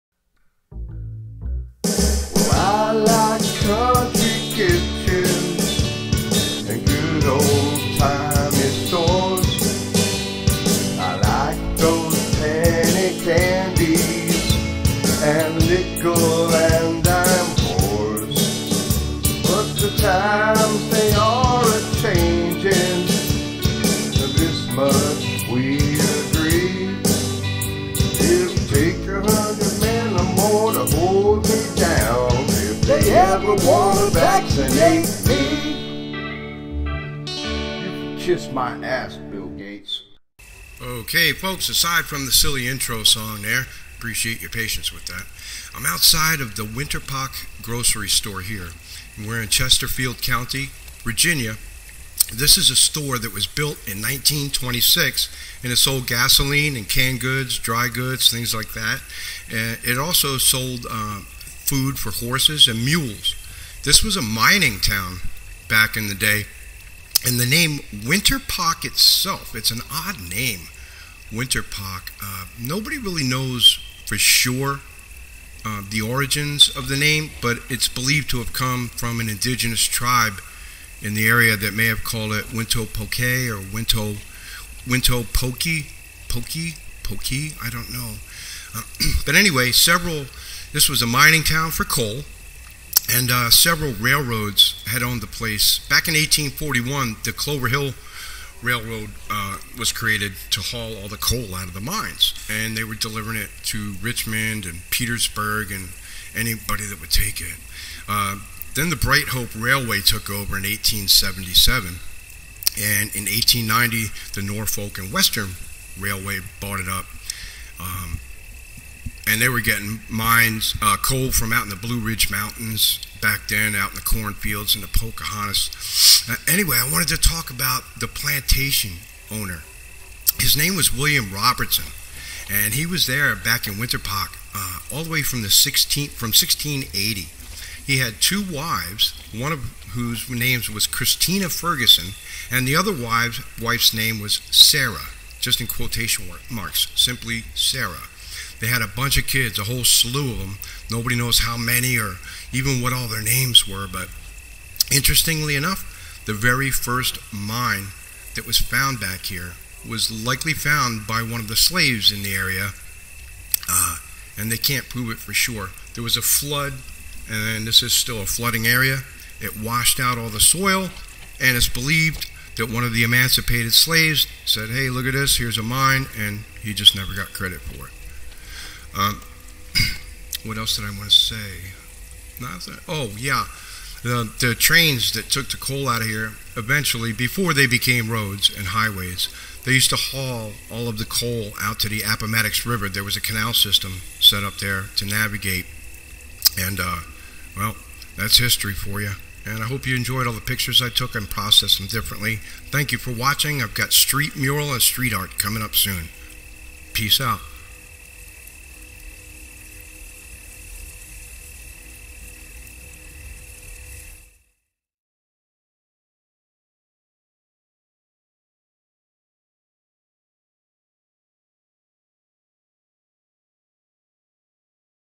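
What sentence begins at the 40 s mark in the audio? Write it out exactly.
Okay, folks, aside from the silly intro song there, appreciate your patience with that.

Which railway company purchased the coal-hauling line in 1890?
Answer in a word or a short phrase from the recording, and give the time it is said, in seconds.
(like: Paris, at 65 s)
Norfolk and Western Railway, at 114 s.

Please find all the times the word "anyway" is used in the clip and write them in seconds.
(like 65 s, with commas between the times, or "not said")
89 s, 126 s.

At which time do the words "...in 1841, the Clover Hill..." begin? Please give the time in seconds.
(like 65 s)
96 s.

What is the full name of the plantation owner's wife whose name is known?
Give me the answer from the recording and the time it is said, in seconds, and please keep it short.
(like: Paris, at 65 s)
Christina Ferguson, at 140 s.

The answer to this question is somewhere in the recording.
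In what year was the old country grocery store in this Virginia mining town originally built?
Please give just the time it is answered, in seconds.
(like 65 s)
54 s.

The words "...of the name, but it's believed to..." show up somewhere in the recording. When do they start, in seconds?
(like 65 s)
76 s.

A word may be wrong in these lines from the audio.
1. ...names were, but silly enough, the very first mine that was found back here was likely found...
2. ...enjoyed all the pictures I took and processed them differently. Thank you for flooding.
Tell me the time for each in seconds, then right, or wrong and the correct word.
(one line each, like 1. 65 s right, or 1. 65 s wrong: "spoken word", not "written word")
1. 153 s wrong: "interestingly", not "silly"
2. 199 s wrong: "watching", not "flooding".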